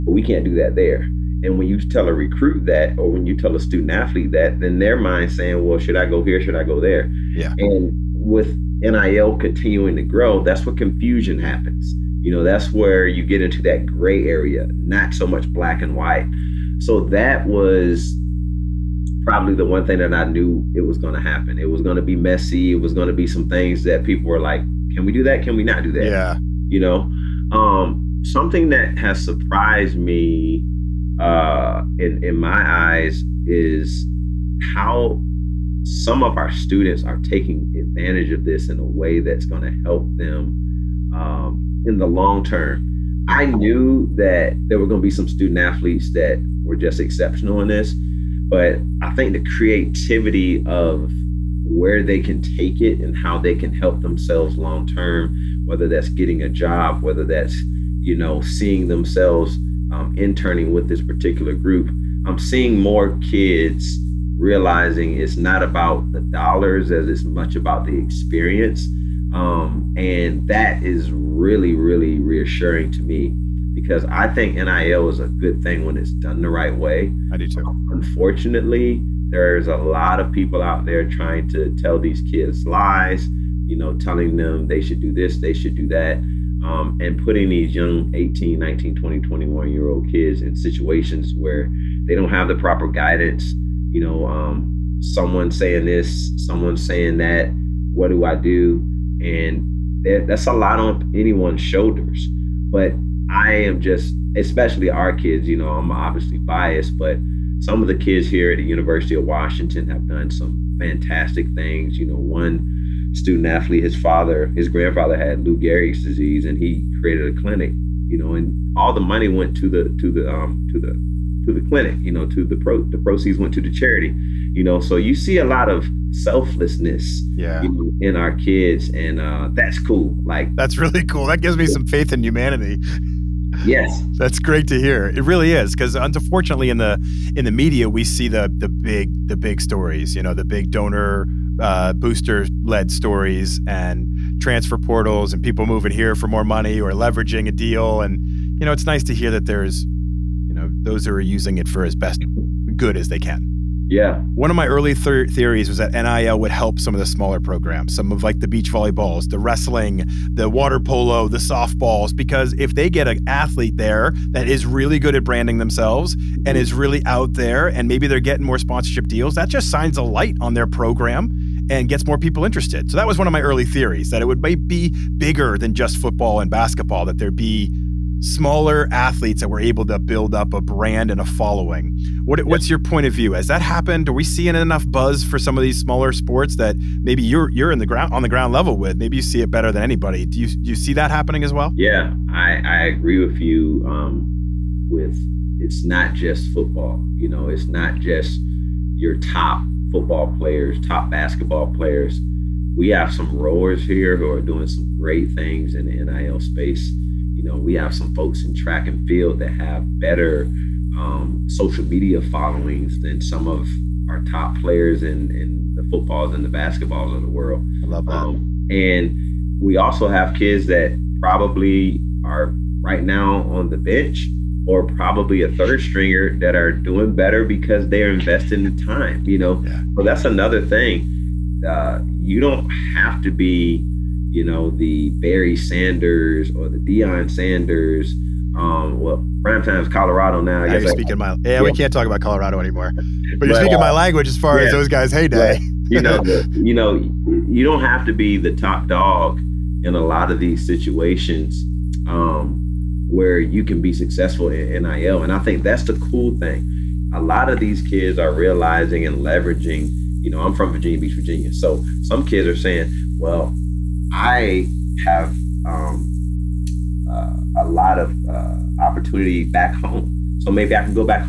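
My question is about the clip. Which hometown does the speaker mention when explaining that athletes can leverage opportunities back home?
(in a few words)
Virginia Beach, Virginia.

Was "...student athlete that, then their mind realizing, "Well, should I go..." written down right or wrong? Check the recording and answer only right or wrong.
wrong.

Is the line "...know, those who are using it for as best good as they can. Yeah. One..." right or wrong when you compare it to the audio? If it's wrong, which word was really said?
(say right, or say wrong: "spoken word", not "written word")
right.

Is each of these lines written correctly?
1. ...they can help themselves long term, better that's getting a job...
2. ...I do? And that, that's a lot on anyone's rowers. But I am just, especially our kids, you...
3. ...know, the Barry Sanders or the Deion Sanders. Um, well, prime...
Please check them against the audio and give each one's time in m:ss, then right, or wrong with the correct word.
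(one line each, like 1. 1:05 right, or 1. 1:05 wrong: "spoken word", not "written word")
1. 0:53 wrong: "whether", not "better"
2. 1:38 wrong: "shoulders", not "rowers"
3. 3:54 right.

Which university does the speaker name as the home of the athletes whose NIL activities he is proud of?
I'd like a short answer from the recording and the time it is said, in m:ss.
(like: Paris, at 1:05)
University of Washington, at 1:48.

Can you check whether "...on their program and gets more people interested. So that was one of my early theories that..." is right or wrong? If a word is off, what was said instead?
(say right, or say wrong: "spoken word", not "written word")
right.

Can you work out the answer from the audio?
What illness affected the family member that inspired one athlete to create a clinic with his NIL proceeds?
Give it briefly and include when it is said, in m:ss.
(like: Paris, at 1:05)
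Lou Gehrig's disease, at 1:55.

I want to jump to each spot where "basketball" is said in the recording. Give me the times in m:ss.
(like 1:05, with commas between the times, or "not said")
2:56, 3:21, 3:36.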